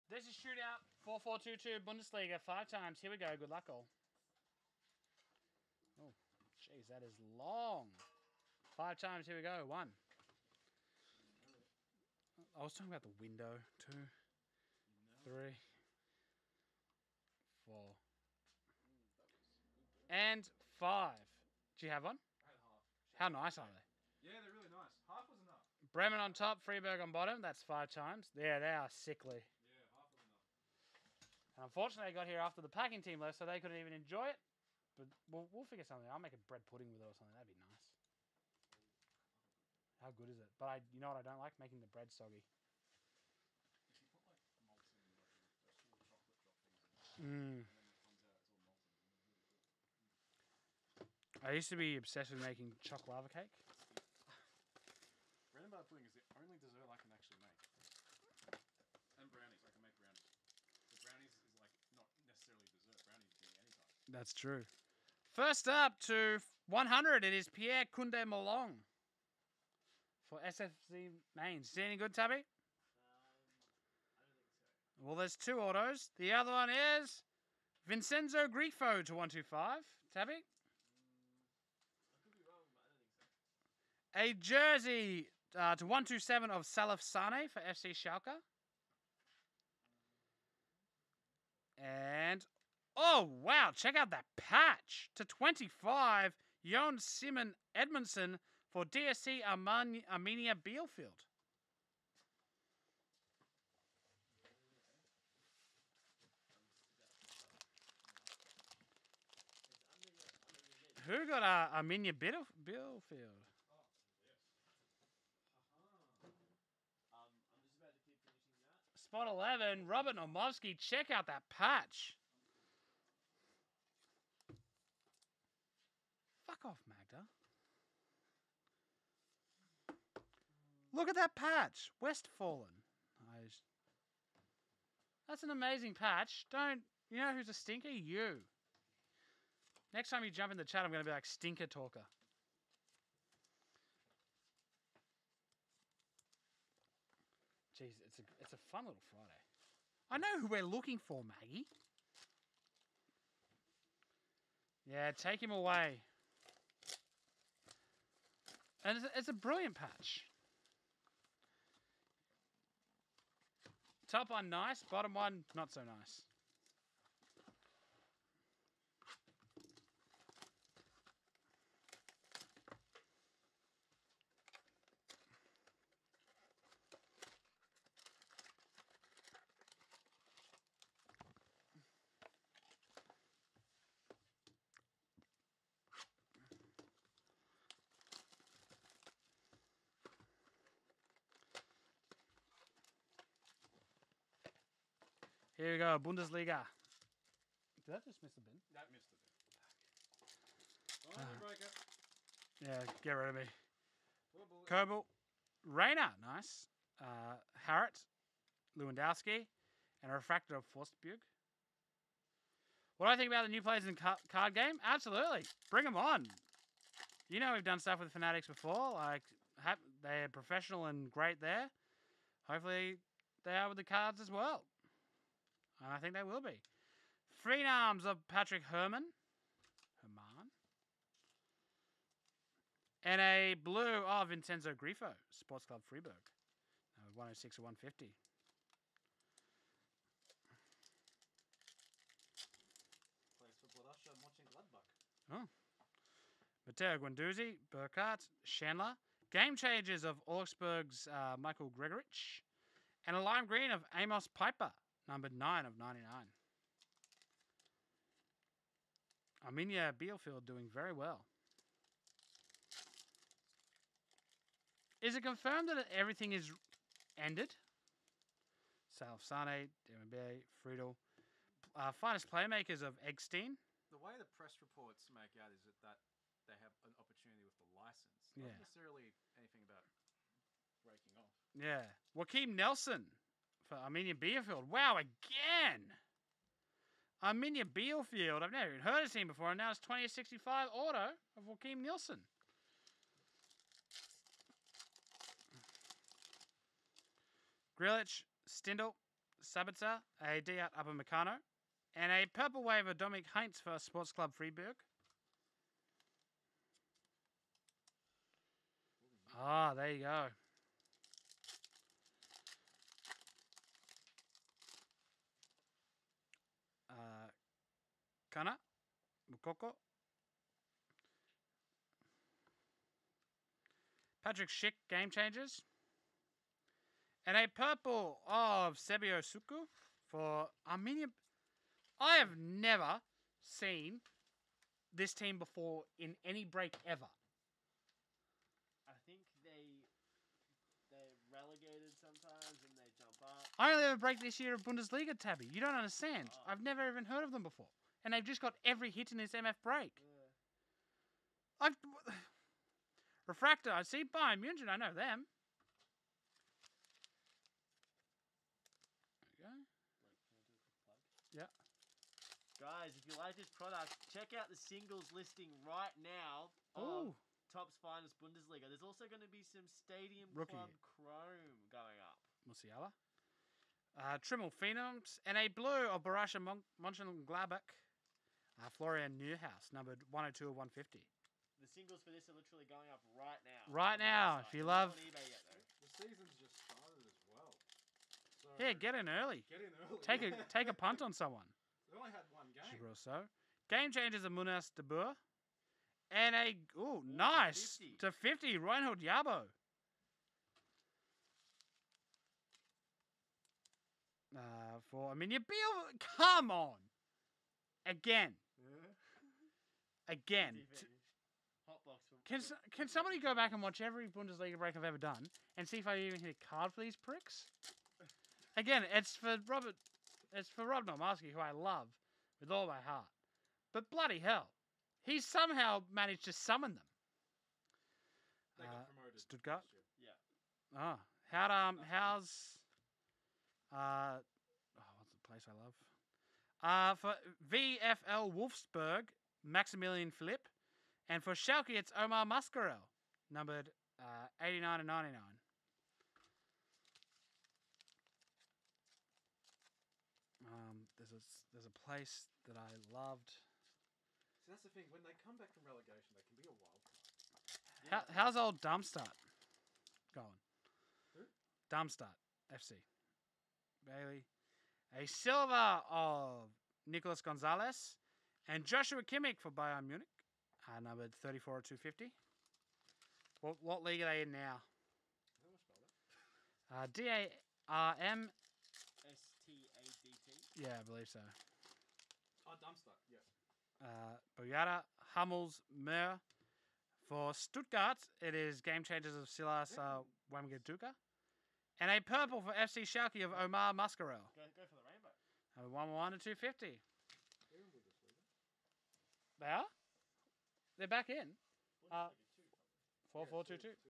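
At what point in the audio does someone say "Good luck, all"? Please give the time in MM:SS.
00:03.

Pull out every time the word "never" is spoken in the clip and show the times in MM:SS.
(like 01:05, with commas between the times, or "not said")
04:48, 05:32, 05:46.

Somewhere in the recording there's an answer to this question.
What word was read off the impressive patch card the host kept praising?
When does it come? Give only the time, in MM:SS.
02:12.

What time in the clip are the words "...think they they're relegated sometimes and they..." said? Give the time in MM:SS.
05:39.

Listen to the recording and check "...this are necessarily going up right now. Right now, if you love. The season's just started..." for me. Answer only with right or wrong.
wrong.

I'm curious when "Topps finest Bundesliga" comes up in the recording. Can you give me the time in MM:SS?
06:07.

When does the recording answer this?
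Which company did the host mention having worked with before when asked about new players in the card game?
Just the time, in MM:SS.
03:38.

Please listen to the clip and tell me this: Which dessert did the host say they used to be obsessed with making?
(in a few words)
Chocolate lava cake.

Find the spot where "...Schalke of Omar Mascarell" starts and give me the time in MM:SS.
08:12.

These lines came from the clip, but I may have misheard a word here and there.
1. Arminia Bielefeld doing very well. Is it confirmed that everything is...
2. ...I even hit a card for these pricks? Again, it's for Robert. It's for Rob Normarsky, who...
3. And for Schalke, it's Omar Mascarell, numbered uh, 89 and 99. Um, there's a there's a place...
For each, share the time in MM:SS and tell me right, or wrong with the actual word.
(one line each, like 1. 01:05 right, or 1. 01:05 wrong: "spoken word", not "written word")
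1. 04:19 right
2. 06:55 right
3. 07:21 right.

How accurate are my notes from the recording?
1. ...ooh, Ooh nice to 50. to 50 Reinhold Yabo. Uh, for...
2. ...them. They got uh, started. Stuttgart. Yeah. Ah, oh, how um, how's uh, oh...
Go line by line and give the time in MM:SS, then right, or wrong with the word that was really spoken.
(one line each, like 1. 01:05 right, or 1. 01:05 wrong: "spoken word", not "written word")
1. 06:36 right
2. 07:06 wrong: "promoted", not "started".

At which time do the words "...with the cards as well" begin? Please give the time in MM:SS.
03:43.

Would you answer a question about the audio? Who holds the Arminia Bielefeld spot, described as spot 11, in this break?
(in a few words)
Robert Nomovsky.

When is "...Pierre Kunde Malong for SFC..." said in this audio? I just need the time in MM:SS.
01:07.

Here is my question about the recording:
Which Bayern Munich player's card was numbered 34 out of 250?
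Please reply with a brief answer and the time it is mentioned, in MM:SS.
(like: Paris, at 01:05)
Joshua Kimmich, at 07:48.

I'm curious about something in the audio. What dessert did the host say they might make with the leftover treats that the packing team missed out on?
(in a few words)
Bread pudding.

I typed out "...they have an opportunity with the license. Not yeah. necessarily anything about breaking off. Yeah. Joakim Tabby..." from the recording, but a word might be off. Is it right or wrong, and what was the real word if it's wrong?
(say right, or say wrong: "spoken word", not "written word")
wrong: "Nilsson", not "Tabby".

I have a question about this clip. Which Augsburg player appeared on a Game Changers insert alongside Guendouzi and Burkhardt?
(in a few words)
Michael Gregoritsch.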